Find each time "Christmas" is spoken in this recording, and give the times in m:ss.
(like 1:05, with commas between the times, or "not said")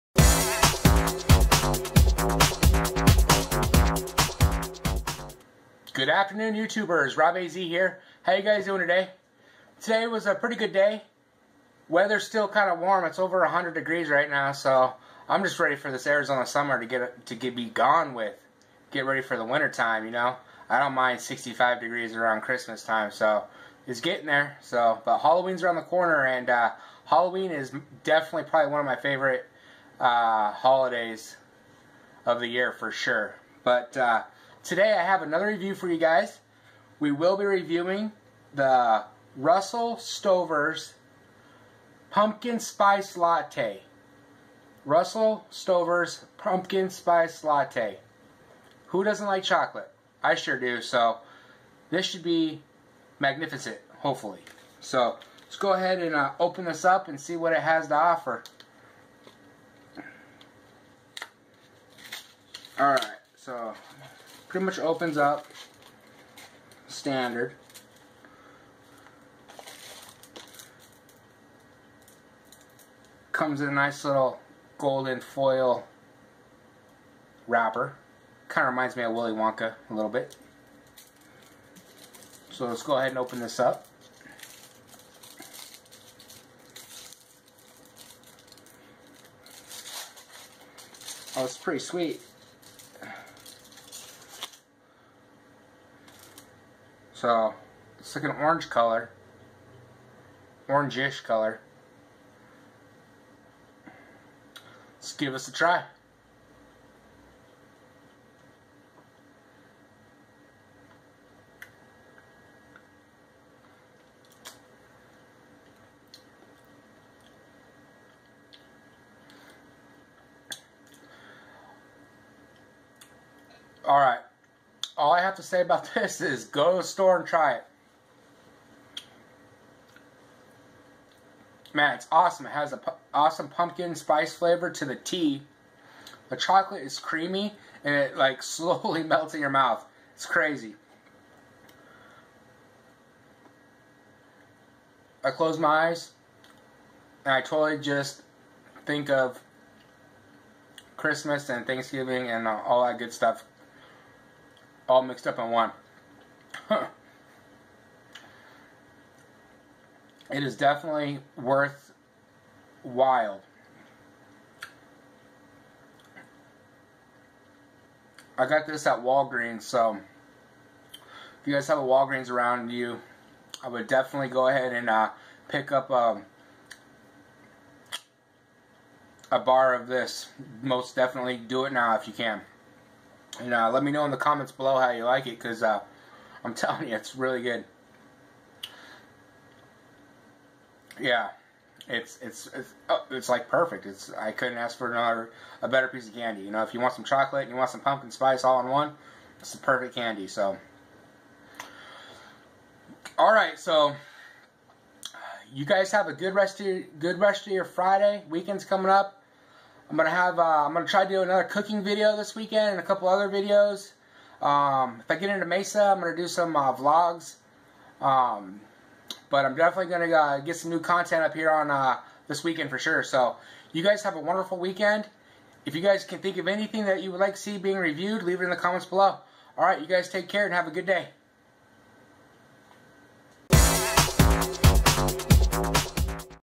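0:22, 2:30.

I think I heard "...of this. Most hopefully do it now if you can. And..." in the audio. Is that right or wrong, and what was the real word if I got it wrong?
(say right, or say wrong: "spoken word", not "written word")
wrong: "definitely", not "hopefully".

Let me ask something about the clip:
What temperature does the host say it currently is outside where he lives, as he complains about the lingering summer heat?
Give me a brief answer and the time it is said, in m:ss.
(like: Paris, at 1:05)
over 100 degrees, at 0:13.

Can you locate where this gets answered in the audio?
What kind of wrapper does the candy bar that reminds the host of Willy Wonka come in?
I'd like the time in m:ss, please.
1:14.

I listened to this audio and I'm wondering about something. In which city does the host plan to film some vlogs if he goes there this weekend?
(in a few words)
Mesa.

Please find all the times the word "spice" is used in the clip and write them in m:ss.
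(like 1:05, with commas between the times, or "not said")
0:42, 0:46, 2:13, 3:18.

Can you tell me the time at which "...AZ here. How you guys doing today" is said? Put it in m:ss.
0:07.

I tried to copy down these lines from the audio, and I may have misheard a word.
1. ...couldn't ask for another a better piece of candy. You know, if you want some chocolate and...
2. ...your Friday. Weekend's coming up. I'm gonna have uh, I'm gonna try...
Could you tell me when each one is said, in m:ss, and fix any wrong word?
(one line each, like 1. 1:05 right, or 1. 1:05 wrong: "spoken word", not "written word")
1. 3:14 right
2. 3:27 right.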